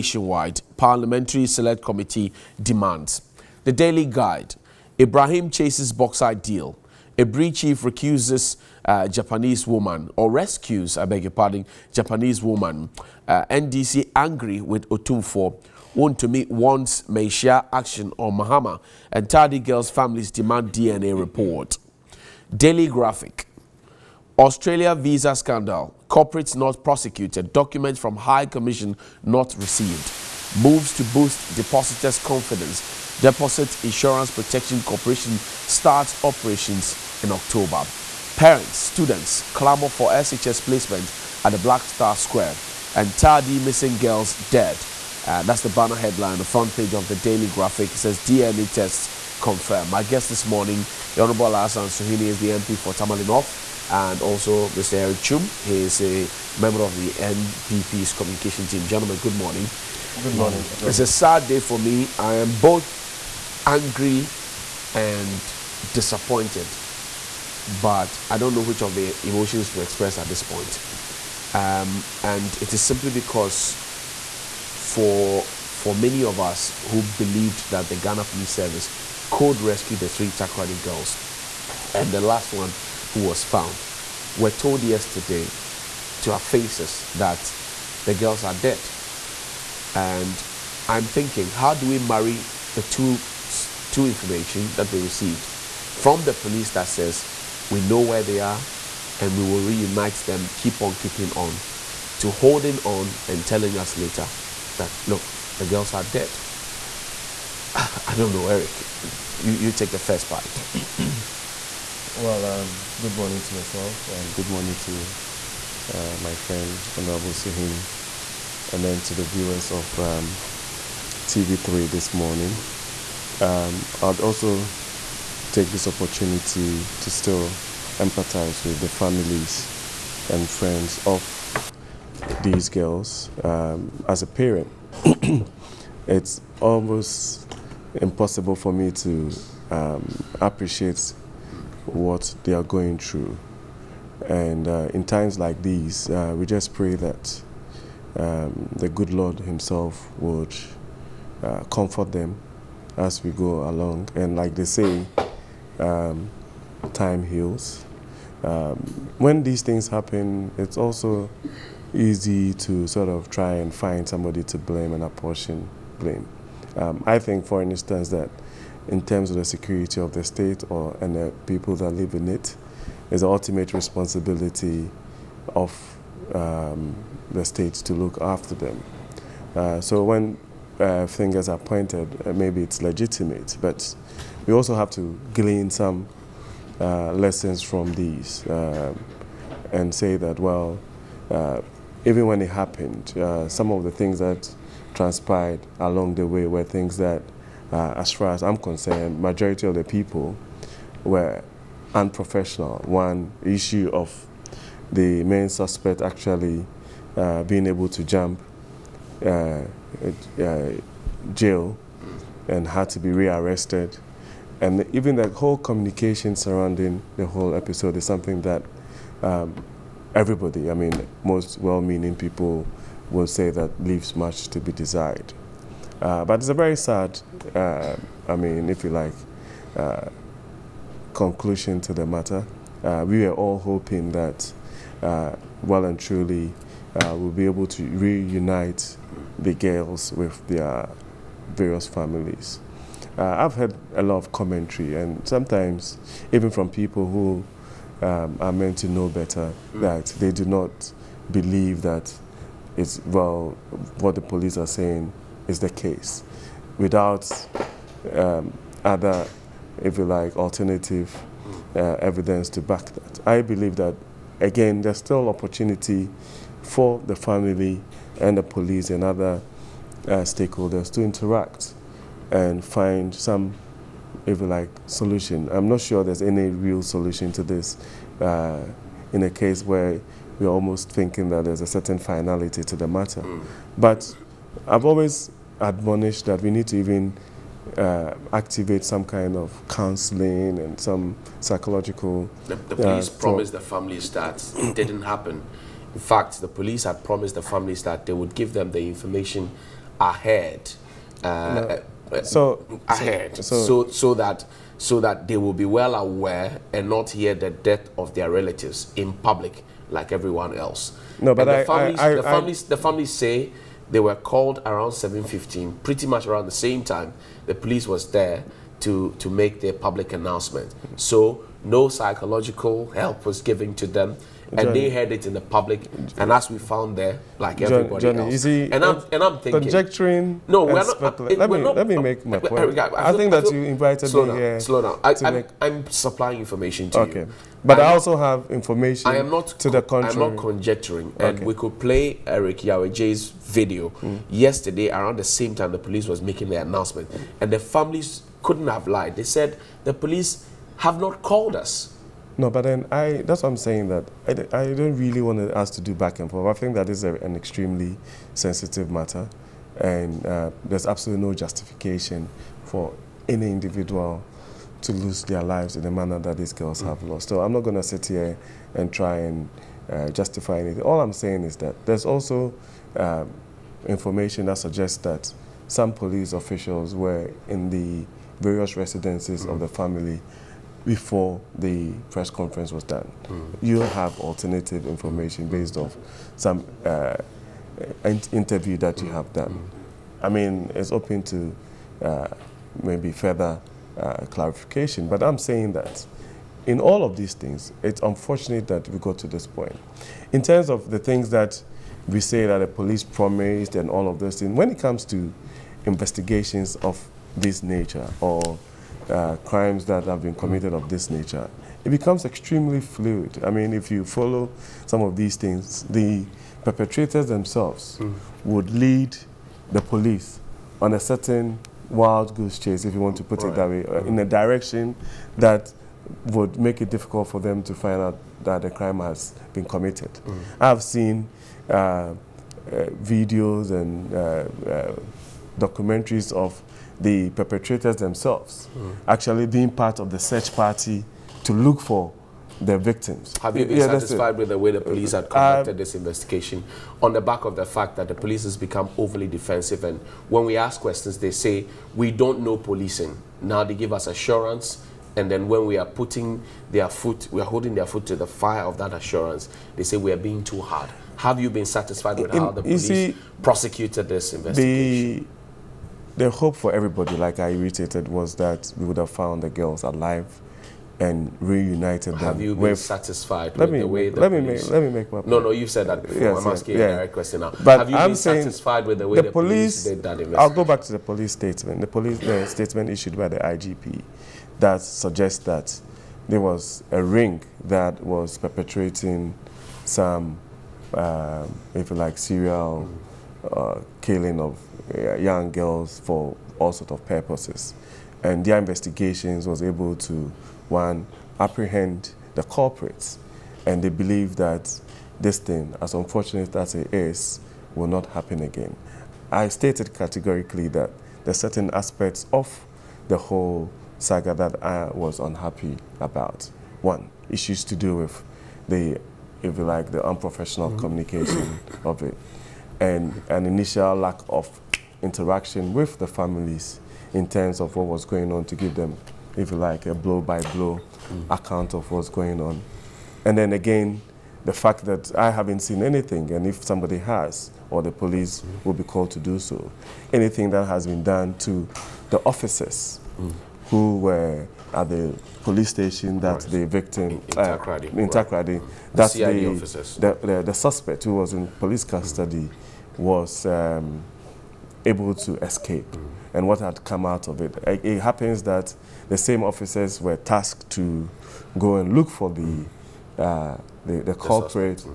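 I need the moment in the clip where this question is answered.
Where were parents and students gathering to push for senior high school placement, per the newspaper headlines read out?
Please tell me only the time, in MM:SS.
00:41.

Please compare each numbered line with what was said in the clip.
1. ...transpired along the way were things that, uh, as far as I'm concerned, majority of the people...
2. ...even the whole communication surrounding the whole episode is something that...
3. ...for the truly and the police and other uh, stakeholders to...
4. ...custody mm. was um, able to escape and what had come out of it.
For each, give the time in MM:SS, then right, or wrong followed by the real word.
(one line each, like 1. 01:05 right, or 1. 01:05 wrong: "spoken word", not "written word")
1. 03:14 right
2. 03:34 right
3. 04:26 wrong: "family", not "truly"
4. 09:11 right.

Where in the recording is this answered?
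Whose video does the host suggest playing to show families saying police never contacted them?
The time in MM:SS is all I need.
05:42.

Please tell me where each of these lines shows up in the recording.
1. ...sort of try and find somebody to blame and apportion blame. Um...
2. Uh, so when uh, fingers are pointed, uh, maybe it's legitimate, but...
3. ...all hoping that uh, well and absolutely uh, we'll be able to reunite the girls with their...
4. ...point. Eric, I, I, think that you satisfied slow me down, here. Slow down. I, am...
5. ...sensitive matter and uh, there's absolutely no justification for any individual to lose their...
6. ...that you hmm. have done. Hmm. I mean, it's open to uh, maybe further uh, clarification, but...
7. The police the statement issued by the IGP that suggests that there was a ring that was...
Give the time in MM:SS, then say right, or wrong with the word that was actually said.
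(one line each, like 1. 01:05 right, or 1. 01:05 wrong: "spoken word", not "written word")
1. 02:42 right
2. 02:59 right
3. 03:53 wrong: "truly", not "absolutely"
4. 05:32 wrong: "invited", not "satisfied"
5. 05:58 right
6. 06:28 right
7. 08:01 right.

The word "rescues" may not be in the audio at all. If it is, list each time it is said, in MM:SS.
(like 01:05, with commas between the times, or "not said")
00:10, 01:19.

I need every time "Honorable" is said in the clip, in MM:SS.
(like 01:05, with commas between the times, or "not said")
00:51, 01:56.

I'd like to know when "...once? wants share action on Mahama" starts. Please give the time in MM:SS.
00:16.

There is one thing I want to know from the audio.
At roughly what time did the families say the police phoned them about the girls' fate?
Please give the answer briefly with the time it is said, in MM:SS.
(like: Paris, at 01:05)
7:15, at 05:14.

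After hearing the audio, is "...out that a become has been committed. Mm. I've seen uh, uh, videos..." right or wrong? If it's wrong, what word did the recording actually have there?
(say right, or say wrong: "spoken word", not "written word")
wrong: "crime", not "become".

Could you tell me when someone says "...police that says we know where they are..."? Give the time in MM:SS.
01:36.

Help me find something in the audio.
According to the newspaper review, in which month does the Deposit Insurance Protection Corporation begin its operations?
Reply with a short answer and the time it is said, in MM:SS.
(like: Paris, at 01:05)
October, at 00:37.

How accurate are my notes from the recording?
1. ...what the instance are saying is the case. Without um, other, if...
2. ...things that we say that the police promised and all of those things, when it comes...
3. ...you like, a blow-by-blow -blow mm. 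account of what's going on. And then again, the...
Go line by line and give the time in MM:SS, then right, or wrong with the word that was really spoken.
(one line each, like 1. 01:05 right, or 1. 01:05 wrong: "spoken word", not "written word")
1. 04:14 wrong: "police", not "instance"
2. 06:40 right
3. 08:49 right.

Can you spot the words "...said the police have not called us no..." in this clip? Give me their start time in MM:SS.
05:49.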